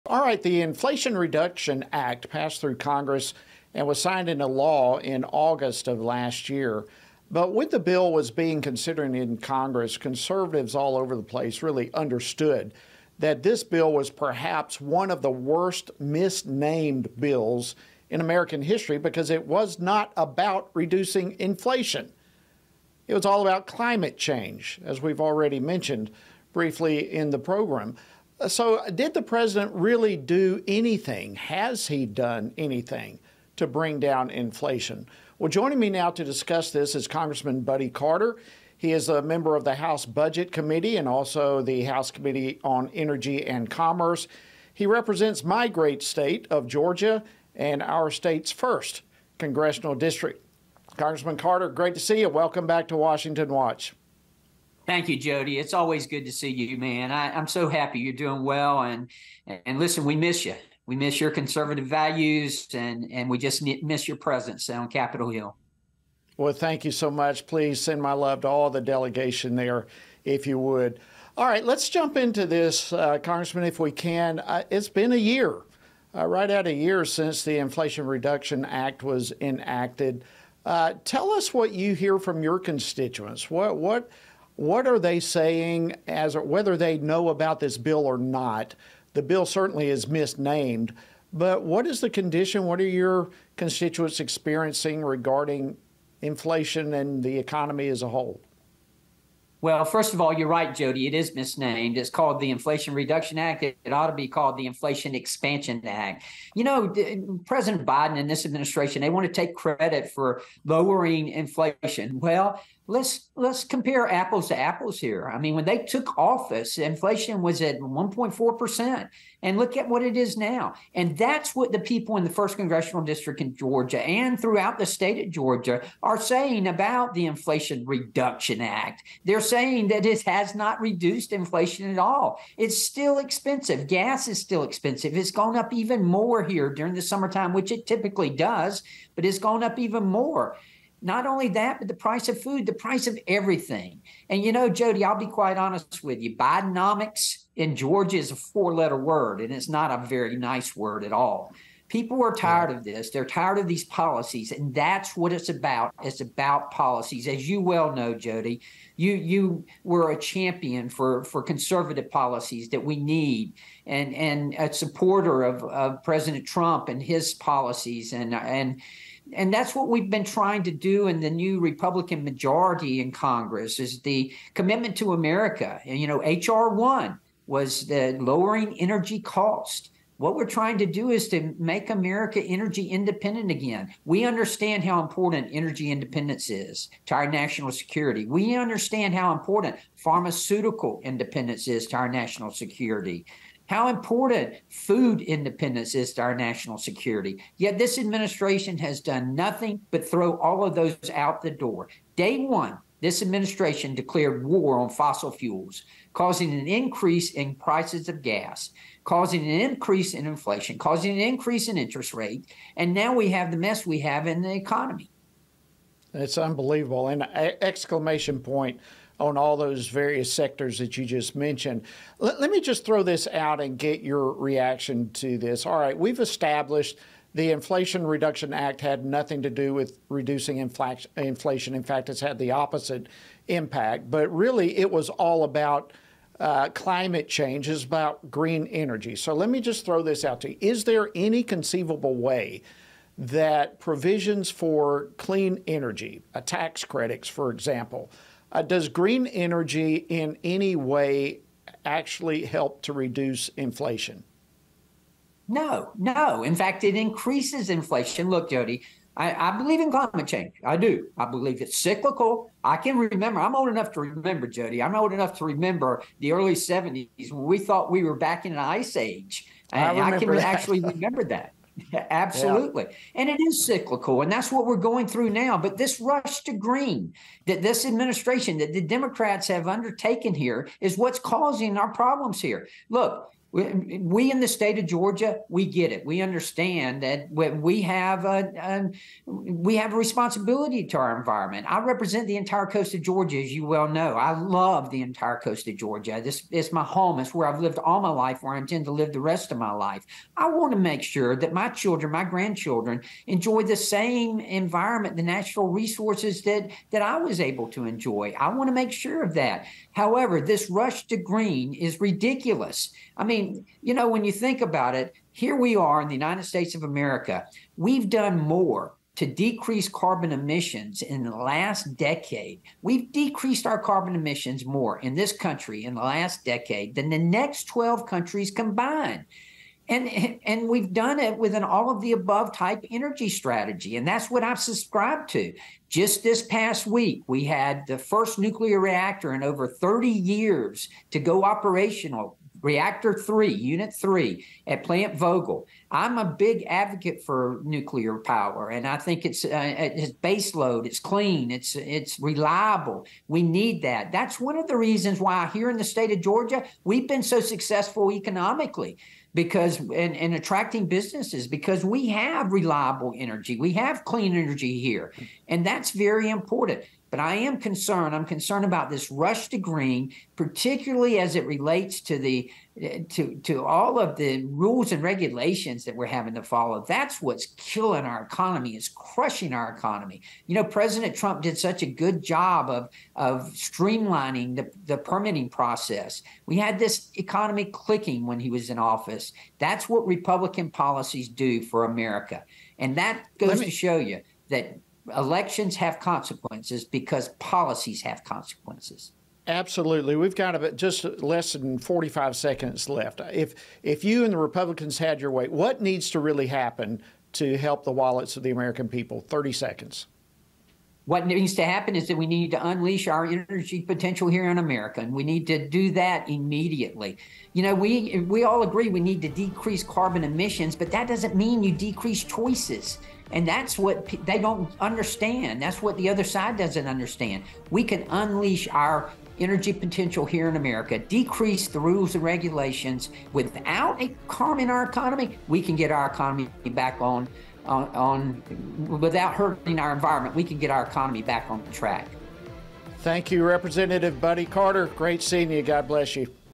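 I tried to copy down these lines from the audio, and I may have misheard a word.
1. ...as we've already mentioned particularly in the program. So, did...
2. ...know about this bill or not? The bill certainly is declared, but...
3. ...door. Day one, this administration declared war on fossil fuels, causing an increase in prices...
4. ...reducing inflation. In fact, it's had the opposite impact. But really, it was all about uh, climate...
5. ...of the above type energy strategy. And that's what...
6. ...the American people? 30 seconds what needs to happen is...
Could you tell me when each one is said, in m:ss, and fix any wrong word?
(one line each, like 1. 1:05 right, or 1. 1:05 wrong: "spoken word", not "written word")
1. 0:24 wrong: "briefly", not "particularly"
2. 1:26 wrong: "misnamed", not "declared"
3. 3:21 right
4. 3:50 right
5. 5:31 right
6. 6:48 right.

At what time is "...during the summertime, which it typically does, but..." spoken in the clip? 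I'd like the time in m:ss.
2:16.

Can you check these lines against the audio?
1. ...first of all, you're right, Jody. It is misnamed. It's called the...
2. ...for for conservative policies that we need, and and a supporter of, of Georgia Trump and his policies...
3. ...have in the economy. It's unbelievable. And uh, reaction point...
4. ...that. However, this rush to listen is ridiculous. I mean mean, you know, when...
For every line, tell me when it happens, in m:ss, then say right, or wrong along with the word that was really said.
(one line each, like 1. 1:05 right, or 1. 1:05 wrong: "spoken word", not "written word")
1. 1:39 right
2. 2:40 wrong: "President", not "Georgia"
3. 3:33 wrong: "exclamation", not "reaction"
4. 5:09 wrong: "green", not "listen".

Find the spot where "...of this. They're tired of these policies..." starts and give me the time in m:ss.
2:32.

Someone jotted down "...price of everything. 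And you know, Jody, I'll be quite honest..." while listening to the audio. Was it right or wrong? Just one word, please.
right.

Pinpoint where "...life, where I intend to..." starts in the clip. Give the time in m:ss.
4:58.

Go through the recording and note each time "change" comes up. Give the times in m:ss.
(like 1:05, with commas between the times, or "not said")
0:24, 3:57, 4:20.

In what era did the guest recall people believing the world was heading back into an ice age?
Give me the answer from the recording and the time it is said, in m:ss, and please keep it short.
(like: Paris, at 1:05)
Early 70s, at 4:26.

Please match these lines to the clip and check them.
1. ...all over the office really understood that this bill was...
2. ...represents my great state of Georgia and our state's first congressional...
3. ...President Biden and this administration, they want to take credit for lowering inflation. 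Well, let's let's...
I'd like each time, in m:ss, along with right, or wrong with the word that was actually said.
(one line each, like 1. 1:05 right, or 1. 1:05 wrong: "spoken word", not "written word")
1. 0:10 wrong: "place", not "office"
2. 0:44 right
3. 1:47 right.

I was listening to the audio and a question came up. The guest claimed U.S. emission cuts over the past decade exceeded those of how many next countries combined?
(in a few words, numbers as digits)
12.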